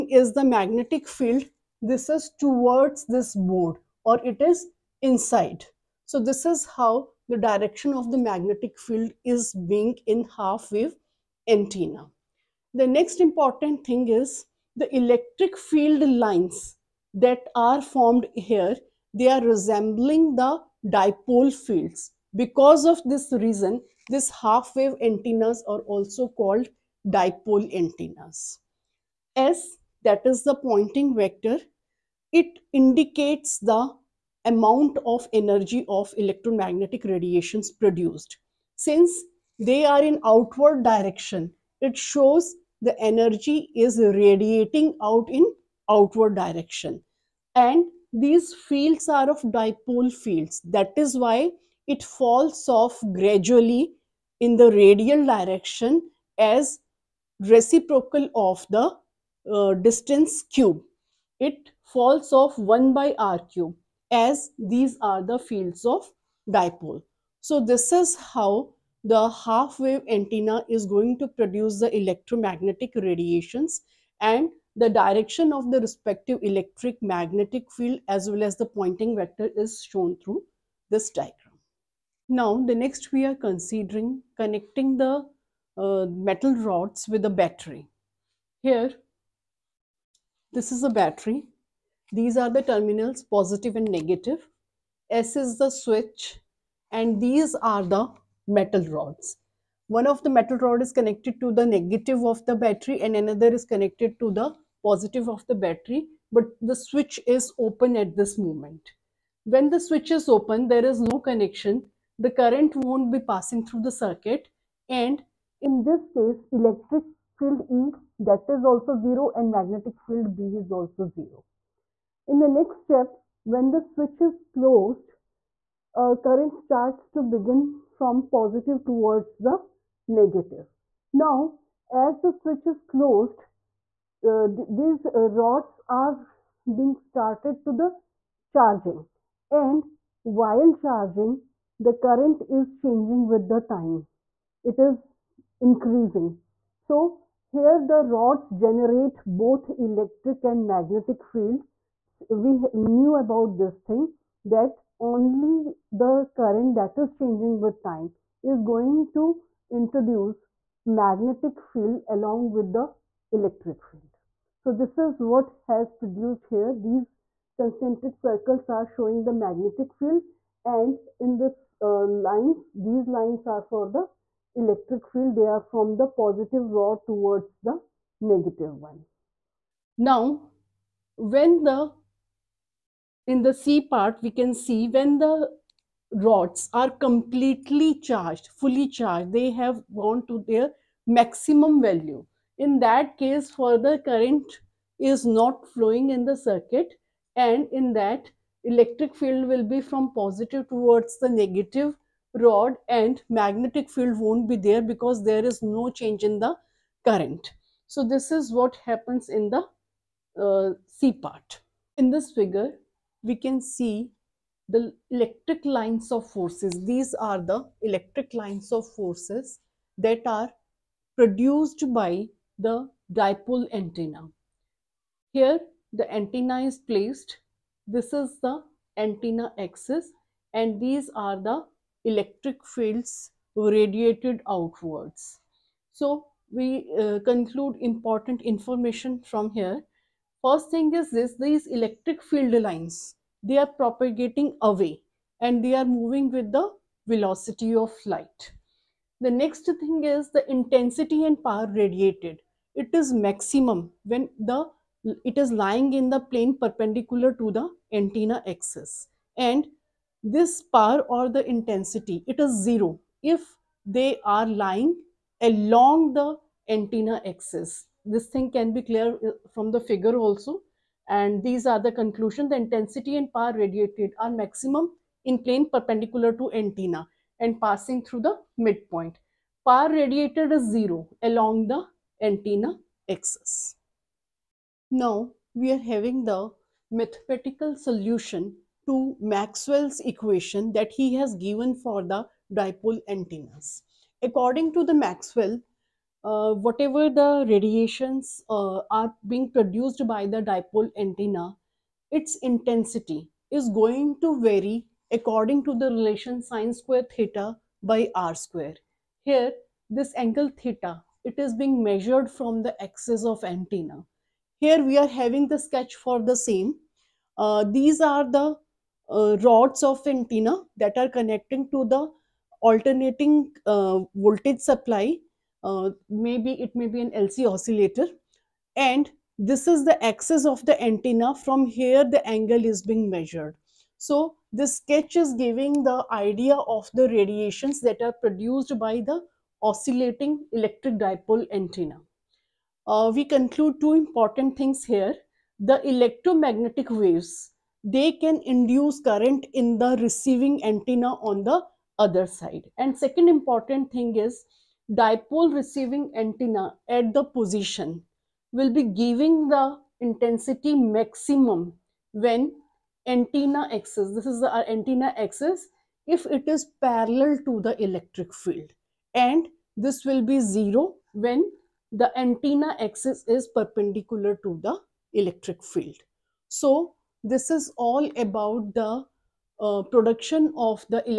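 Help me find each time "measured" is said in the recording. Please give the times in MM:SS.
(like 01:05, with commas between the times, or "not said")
05:11, 05:33.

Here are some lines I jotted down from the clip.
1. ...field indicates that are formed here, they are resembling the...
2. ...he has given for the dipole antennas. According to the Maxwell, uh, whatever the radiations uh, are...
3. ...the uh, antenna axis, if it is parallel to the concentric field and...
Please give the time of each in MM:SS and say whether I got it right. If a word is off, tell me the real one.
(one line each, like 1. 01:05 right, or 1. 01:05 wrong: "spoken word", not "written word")
1. 00:15 wrong: "lines", not "indicates"
2. 04:50 right
3. 06:04 wrong: "electric", not "concentric".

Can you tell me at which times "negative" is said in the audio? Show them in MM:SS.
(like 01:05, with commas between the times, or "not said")
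01:33, 01:41, 02:10, 02:58, 03:21.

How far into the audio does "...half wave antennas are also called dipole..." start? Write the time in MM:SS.
00:24.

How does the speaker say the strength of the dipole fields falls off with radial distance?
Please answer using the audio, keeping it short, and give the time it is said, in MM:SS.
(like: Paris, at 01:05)
1/r³, at 01:02.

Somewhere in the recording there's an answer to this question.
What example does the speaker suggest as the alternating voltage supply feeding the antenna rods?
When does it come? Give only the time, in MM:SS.
05:27.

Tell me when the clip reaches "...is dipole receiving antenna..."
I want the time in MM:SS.
05:54.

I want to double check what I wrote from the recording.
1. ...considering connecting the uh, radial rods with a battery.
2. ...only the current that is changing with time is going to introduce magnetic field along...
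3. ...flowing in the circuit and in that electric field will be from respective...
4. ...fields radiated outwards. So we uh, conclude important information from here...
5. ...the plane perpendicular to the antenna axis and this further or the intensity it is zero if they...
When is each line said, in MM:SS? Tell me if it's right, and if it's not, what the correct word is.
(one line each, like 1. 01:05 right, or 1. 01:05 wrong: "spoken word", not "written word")
1. 01:23 wrong: "metal", not "radial"
2. 02:35 right
3. 03:15 wrong: "positive", not "respective"
4. 03:52 right
5. 04:16 wrong: "power", not "further".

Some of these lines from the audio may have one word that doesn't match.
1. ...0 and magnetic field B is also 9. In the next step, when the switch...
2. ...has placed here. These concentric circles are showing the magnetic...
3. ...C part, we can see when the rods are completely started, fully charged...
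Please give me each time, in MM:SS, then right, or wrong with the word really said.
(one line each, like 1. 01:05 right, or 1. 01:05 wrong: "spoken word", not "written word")
1. 01:58 wrong: "0", not "9"
2. 02:45 wrong: "produced", not "placed"
3. 03:03 wrong: "charged", not "started".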